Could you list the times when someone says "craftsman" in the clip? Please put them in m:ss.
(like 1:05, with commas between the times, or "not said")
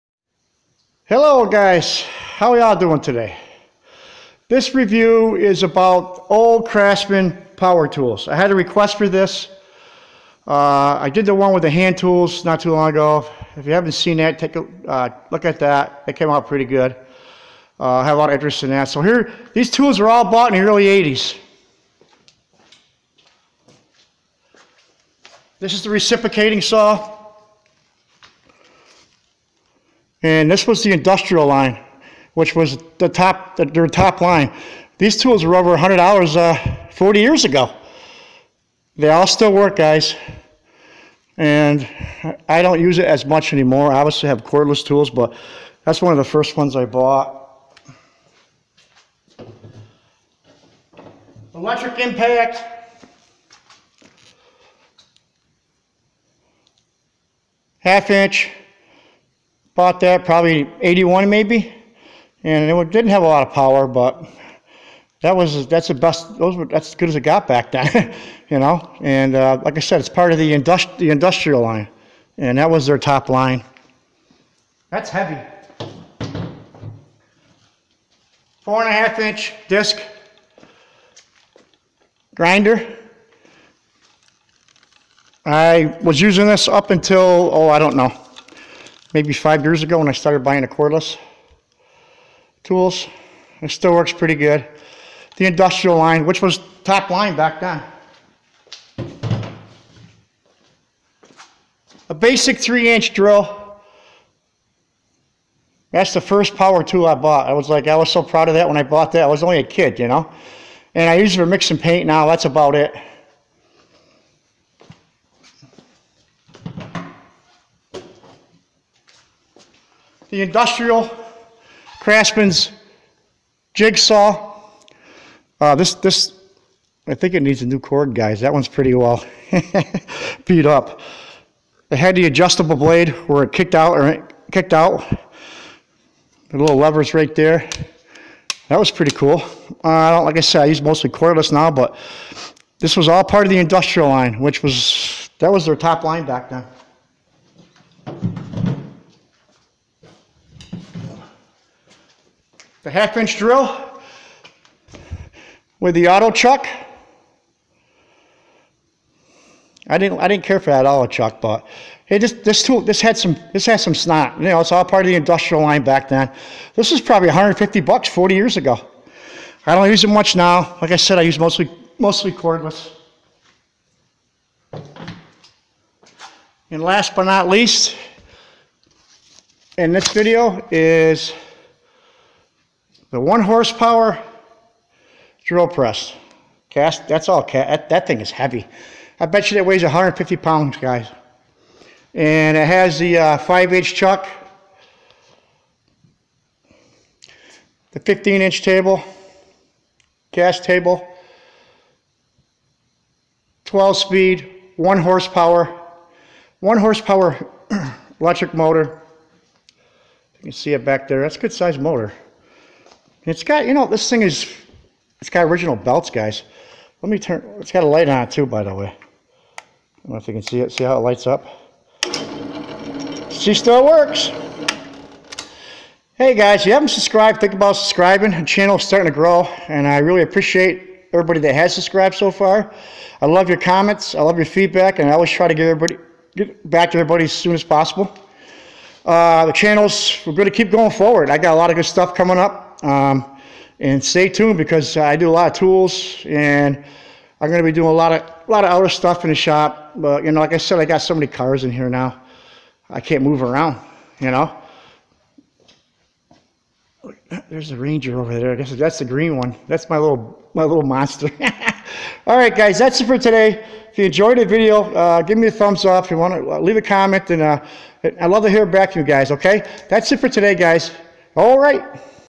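0:06, 2:01.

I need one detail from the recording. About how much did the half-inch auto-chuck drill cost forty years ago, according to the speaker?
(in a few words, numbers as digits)
$150.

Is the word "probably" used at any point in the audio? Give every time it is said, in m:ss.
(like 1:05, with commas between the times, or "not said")
1:00, 2:47.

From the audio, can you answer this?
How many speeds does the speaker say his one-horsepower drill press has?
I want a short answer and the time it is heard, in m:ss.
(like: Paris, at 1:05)
12, at 3:23.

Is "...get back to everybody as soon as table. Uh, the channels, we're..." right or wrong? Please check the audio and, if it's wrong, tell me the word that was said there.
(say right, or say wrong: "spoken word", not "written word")
wrong: "possible", not "table".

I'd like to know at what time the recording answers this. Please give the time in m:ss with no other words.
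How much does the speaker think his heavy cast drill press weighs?
3:09.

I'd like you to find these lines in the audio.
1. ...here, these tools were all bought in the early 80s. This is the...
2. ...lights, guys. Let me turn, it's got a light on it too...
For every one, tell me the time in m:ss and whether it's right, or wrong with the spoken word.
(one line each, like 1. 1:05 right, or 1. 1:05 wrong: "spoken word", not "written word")
1. 0:19 right
2. 3:35 wrong: "belts", not "lights".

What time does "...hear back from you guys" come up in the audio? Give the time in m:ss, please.
4:28.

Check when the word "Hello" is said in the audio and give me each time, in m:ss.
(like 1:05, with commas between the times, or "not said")
0:01.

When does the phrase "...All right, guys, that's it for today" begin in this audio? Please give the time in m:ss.
4:22.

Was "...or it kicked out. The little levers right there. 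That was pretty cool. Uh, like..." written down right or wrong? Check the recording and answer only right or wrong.
right.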